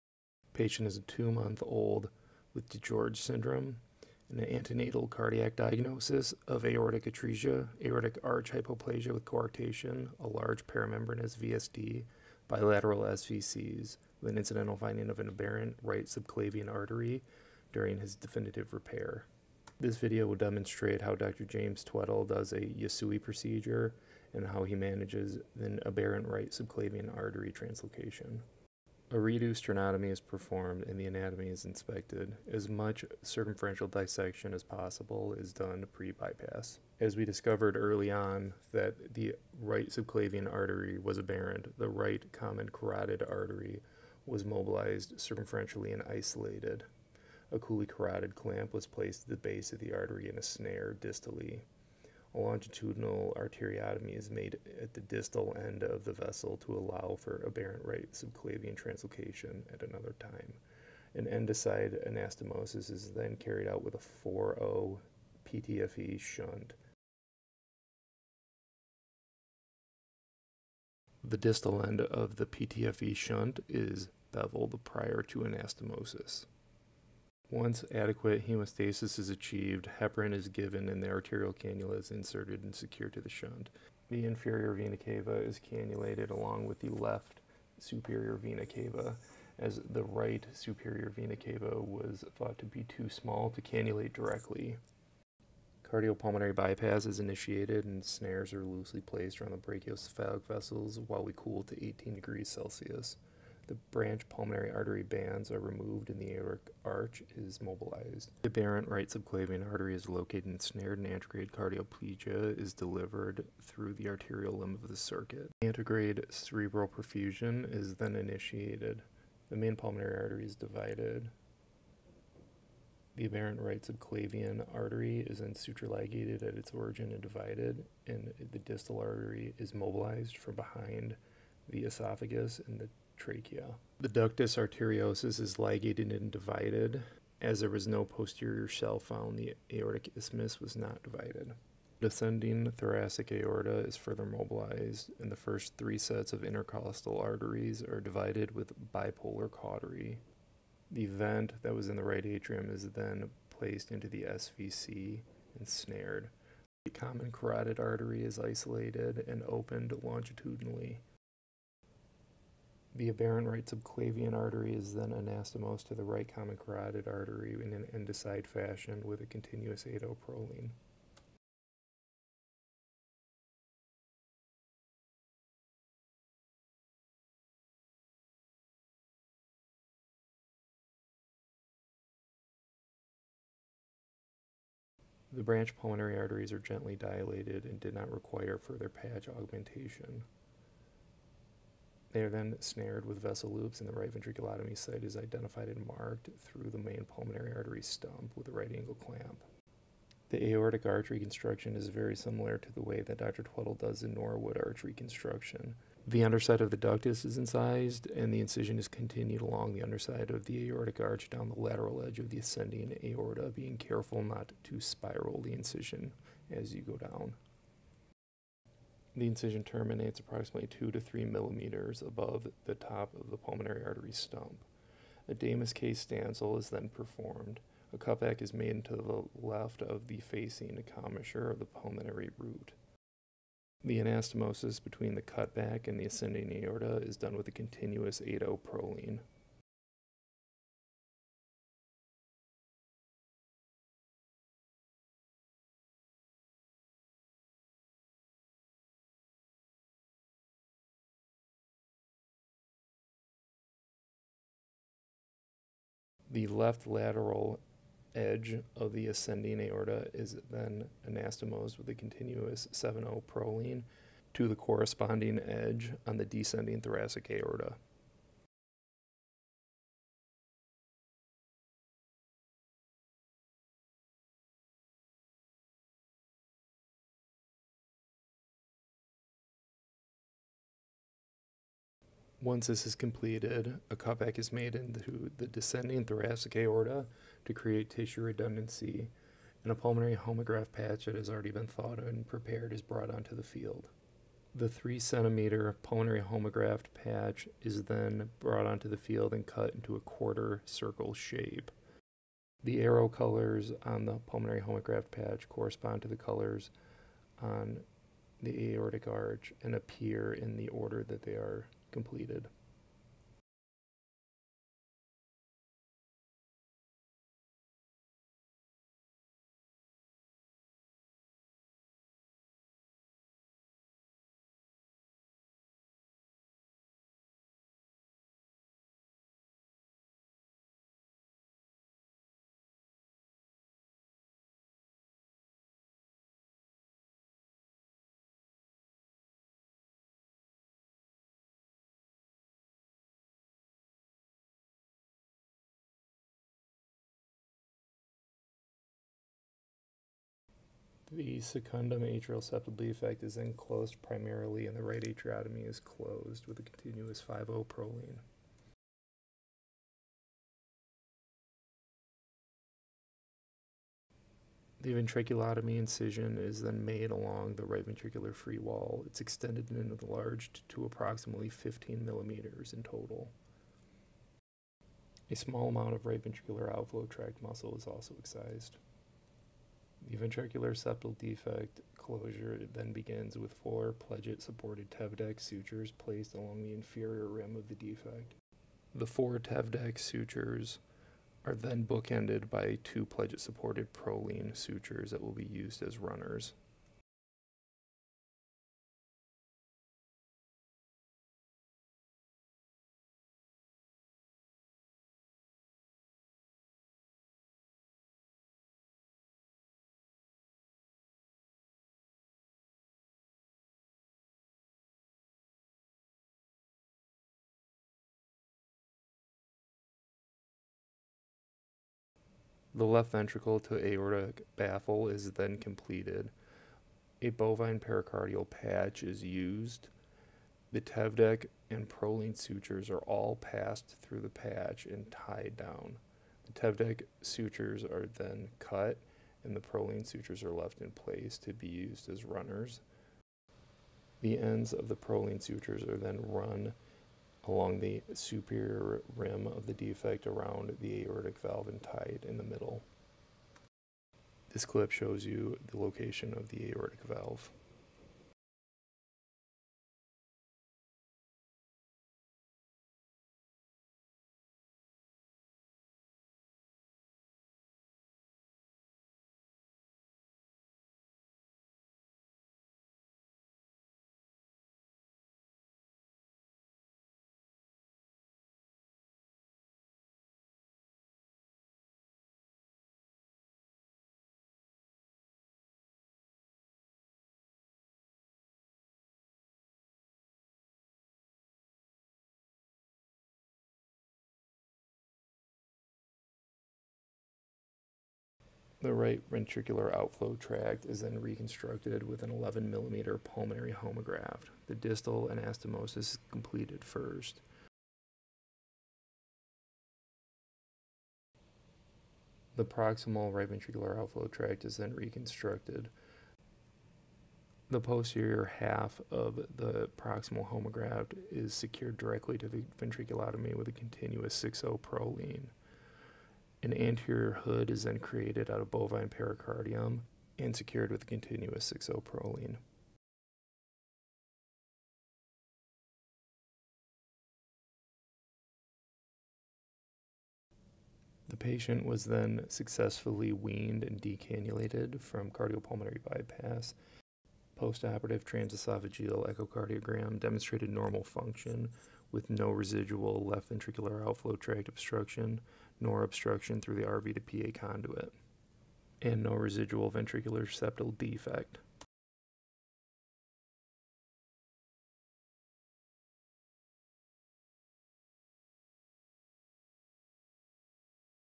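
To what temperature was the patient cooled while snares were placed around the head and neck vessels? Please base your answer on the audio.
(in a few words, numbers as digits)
18 degrees Celsius.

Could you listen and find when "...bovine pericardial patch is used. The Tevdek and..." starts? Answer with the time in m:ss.
7:07.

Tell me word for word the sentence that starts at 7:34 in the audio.
This clip shows you the location of the aortic valve.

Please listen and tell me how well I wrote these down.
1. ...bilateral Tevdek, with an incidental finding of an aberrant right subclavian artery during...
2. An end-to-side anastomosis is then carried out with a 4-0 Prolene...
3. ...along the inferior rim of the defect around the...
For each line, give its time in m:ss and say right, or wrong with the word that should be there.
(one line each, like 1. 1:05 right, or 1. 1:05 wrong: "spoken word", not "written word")
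1. 0:12 wrong: "SVCs", not "Tevdek"
2. 1:01 wrong: "PTFE", not "Prolene"
3. 7:27 wrong: "superior", not "inferior".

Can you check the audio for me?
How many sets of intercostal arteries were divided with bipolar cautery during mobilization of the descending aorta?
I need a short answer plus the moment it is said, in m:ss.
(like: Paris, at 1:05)
3, at 2:25.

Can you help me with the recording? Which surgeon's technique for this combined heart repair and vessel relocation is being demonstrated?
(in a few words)
Dr. James Tweddell.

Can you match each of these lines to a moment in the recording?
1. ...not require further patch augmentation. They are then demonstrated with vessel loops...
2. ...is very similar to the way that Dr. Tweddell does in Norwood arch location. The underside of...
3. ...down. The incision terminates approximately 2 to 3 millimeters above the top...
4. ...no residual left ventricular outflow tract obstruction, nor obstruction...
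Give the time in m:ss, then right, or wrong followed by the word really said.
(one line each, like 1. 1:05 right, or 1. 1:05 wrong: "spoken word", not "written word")
1. 3:07 wrong: "snared", not "demonstrated"
2. 3:21 wrong: "reconstruction", not "location"
3. 3:36 right
4. 9:12 right.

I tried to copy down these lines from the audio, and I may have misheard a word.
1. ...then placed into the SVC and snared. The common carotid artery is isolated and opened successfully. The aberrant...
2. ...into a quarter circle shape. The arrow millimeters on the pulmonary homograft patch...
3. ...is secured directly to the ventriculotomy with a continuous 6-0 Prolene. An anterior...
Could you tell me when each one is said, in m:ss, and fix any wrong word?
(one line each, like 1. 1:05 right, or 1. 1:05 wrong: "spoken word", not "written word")
1. 2:32 wrong: "longitudinally", not "successfully"
2. 4:59 wrong: "colors", not "millimeters"
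3. 8:41 right.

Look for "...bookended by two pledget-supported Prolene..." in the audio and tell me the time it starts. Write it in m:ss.
6:31.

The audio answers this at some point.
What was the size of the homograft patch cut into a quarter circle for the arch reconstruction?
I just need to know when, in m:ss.
4:54.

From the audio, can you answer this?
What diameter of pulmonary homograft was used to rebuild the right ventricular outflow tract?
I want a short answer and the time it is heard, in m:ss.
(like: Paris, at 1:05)
11 millimeter, at 8:22.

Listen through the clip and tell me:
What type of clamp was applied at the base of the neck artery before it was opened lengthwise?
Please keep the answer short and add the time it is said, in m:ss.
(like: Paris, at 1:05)
Cooley carotid clamp, at 0:47.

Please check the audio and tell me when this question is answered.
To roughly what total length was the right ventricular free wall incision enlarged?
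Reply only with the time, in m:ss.
6:11.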